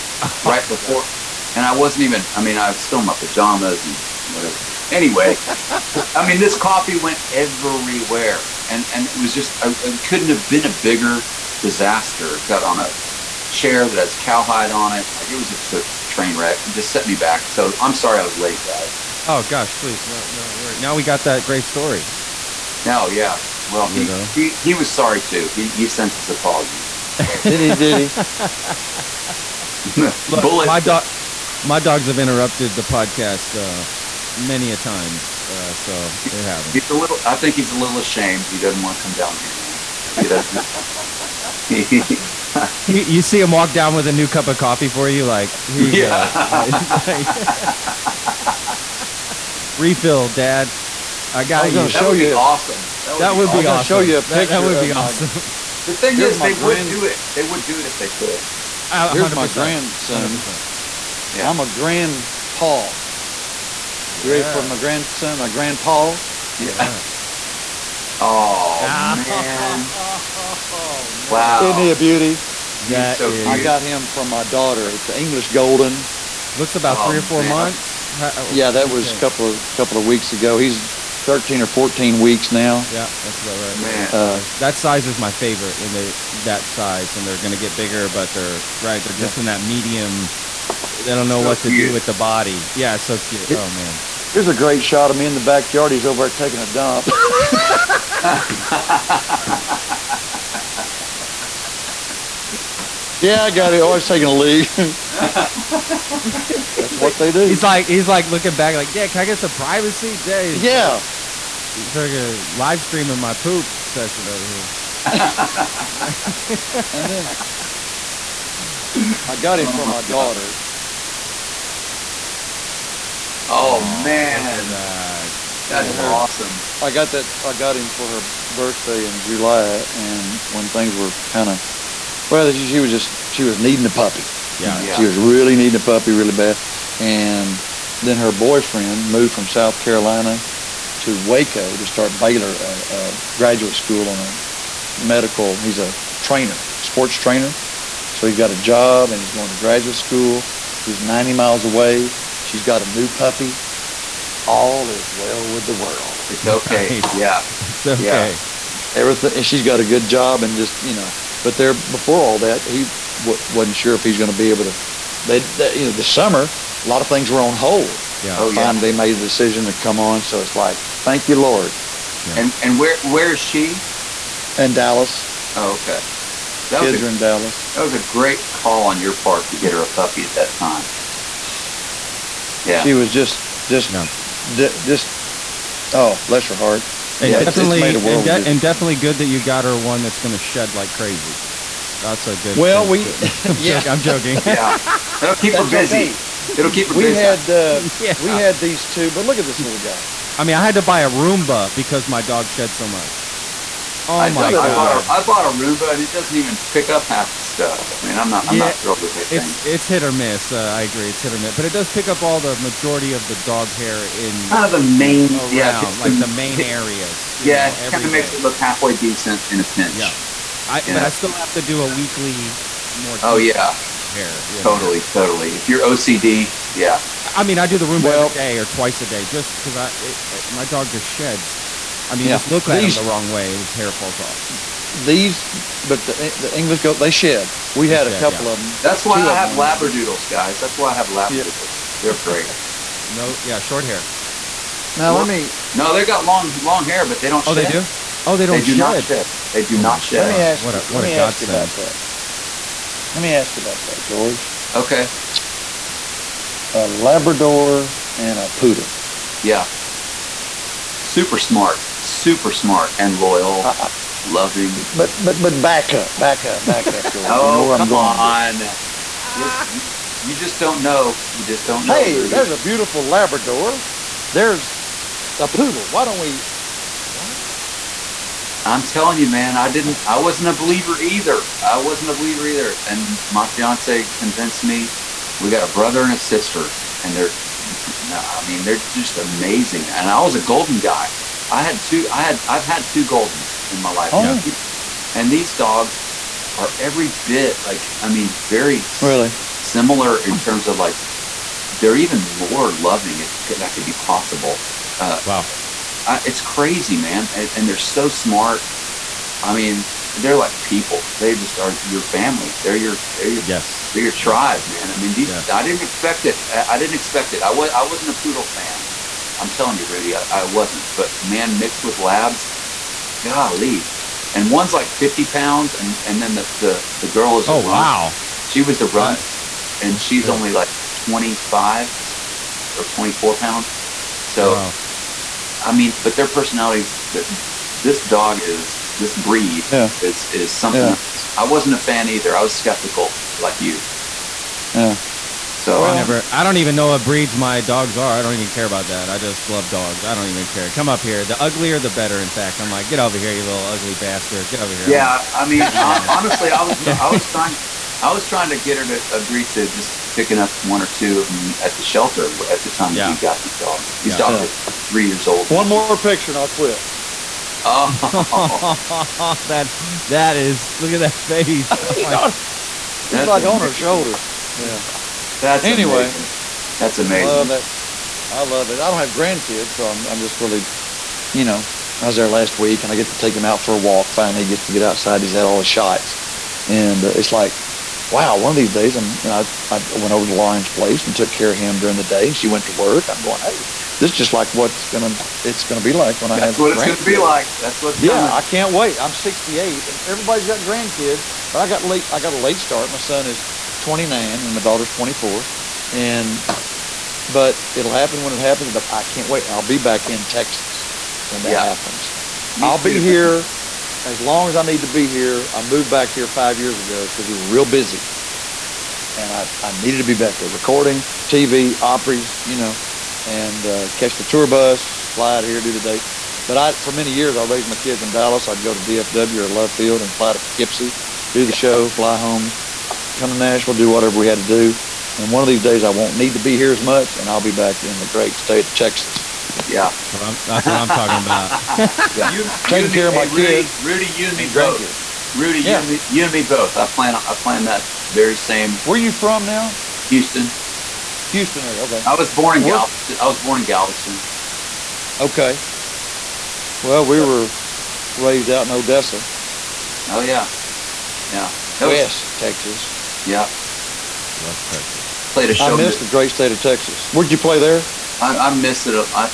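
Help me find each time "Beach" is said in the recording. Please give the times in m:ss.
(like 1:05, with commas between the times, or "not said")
not said.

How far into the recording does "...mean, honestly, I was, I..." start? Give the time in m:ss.
5:55.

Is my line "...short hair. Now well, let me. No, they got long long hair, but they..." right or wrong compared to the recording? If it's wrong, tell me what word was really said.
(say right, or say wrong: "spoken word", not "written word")
right.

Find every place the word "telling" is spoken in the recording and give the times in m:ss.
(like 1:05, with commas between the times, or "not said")
4:38, 5:19.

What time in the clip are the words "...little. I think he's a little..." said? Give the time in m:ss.
0:36.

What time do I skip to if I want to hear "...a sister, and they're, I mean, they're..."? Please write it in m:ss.
4:46.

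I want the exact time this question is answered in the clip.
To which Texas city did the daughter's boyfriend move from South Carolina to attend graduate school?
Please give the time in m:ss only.
2:21.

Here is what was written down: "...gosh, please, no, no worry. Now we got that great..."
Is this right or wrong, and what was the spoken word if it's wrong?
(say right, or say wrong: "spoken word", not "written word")
right.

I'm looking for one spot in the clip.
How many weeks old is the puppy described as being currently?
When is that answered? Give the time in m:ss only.
1:21.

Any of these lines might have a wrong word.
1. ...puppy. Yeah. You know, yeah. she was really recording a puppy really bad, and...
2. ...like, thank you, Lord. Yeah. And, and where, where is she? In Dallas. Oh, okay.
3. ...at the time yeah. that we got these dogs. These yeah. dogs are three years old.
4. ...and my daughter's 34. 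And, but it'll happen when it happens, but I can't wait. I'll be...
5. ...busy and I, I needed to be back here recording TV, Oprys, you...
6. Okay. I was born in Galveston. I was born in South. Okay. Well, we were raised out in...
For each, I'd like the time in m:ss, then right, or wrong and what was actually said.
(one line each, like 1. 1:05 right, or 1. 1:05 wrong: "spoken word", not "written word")
1. 2:13 wrong: "needing", not "recording"
2. 2:50 right
3. 6:02 right
4. 6:44 wrong: "24", not "34"
5. 6:57 right
6. 7:31 wrong: "Galveston", not "South".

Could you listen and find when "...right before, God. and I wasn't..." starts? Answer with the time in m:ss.
0:00.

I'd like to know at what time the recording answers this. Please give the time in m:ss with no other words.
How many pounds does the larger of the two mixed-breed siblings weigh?
5:24.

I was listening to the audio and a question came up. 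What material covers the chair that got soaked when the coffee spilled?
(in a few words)
Cowhide.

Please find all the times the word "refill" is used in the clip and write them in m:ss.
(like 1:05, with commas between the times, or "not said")
0:49.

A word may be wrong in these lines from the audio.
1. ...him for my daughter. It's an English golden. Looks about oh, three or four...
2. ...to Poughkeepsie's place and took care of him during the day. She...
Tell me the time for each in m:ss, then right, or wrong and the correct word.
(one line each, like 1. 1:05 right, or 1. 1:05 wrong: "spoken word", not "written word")
1. 1:13 right
2. 6:30 wrong: "Lauren", not "Poughkeepsie".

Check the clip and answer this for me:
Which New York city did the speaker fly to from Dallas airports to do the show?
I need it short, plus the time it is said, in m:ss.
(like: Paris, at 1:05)
Poughkeepsie, at 7:10.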